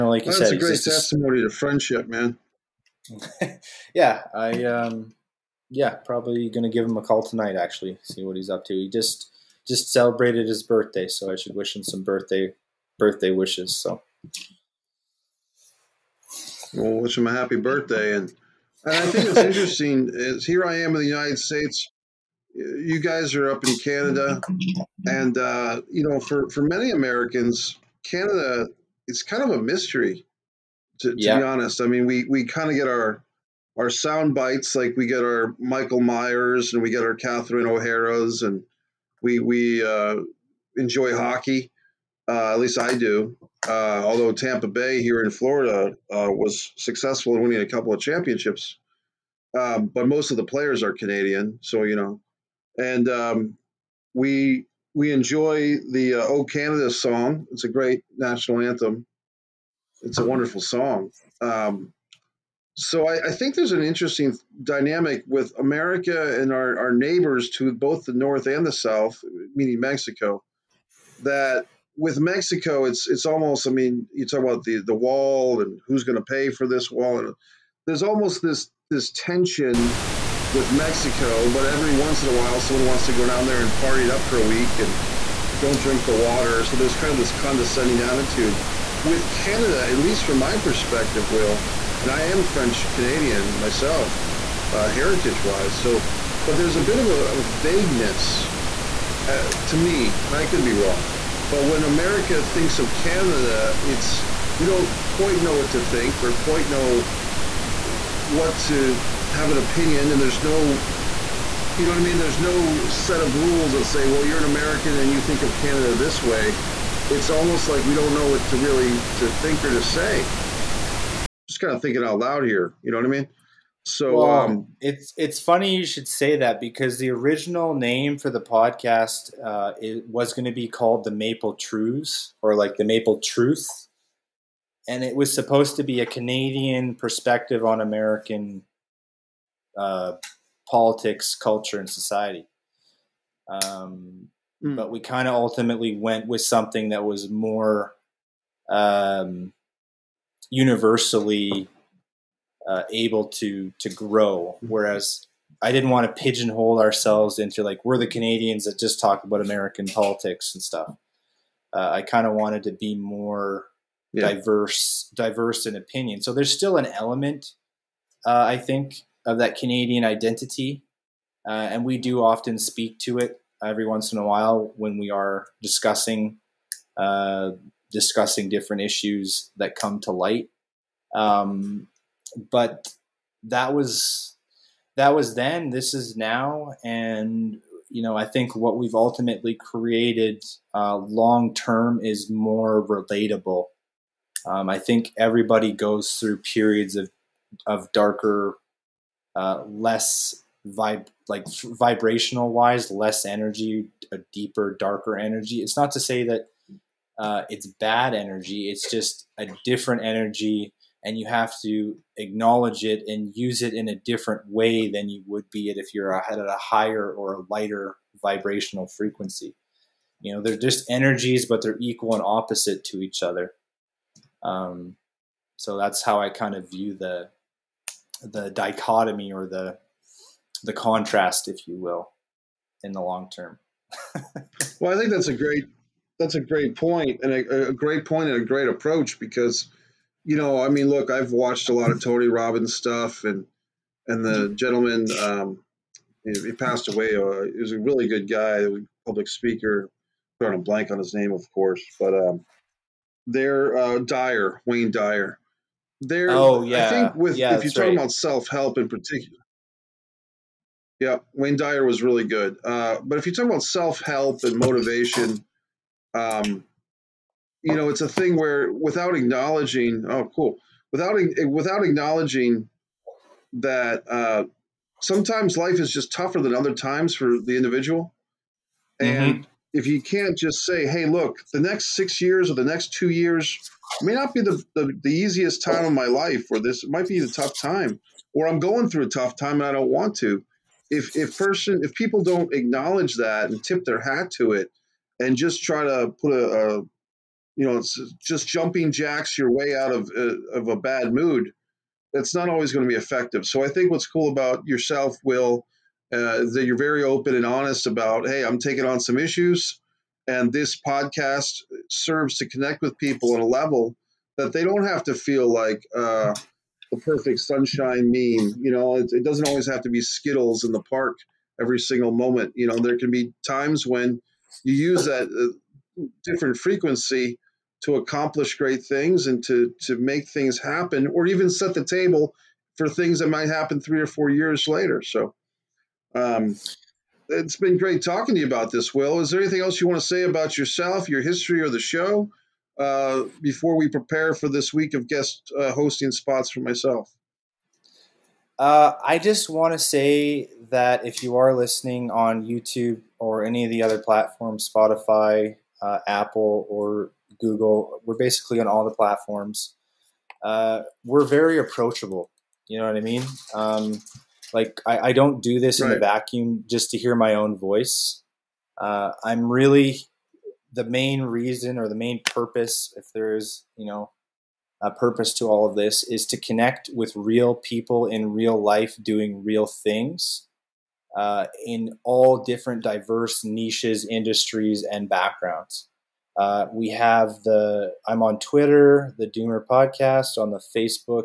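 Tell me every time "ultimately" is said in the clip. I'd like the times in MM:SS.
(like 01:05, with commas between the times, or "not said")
02:25, 03:08.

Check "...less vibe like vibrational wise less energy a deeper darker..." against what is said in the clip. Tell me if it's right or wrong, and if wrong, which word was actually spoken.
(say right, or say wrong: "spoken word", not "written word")
right.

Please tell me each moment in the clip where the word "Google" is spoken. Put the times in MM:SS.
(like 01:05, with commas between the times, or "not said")
05:57.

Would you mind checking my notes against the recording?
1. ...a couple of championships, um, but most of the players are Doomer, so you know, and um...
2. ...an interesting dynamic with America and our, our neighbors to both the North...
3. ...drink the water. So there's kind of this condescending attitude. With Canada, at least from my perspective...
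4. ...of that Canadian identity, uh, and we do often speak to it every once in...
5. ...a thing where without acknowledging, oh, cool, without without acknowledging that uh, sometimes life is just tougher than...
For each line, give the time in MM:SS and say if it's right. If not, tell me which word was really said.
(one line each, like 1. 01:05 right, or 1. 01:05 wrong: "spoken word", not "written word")
1. 00:47 wrong: "Canadian", not "Doomer"
2. 01:03 right
3. 01:25 right
4. 02:49 right
5. 04:28 right.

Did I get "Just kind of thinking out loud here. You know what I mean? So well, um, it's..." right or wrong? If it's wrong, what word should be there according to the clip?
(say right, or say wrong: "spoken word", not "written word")
right.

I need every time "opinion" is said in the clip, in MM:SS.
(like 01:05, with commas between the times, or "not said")
01:49, 02:45.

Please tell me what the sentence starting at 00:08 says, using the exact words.
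He just just celebrated his birthday, so I should wish him some birthday birthday wishes.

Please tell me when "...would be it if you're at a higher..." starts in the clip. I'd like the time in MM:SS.
03:35.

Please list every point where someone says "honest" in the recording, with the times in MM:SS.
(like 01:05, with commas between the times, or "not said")
00:31, 05:07.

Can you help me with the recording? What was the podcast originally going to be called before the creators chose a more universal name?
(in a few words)
The Maple Truth.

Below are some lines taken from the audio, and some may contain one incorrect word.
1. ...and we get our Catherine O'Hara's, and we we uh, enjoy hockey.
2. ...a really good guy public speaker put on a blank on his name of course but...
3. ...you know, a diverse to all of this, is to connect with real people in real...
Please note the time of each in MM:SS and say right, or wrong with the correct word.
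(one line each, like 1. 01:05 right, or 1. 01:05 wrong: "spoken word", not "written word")
1. 00:36 right
2. 04:07 right
3. 06:13 wrong: "purpose", not "diverse".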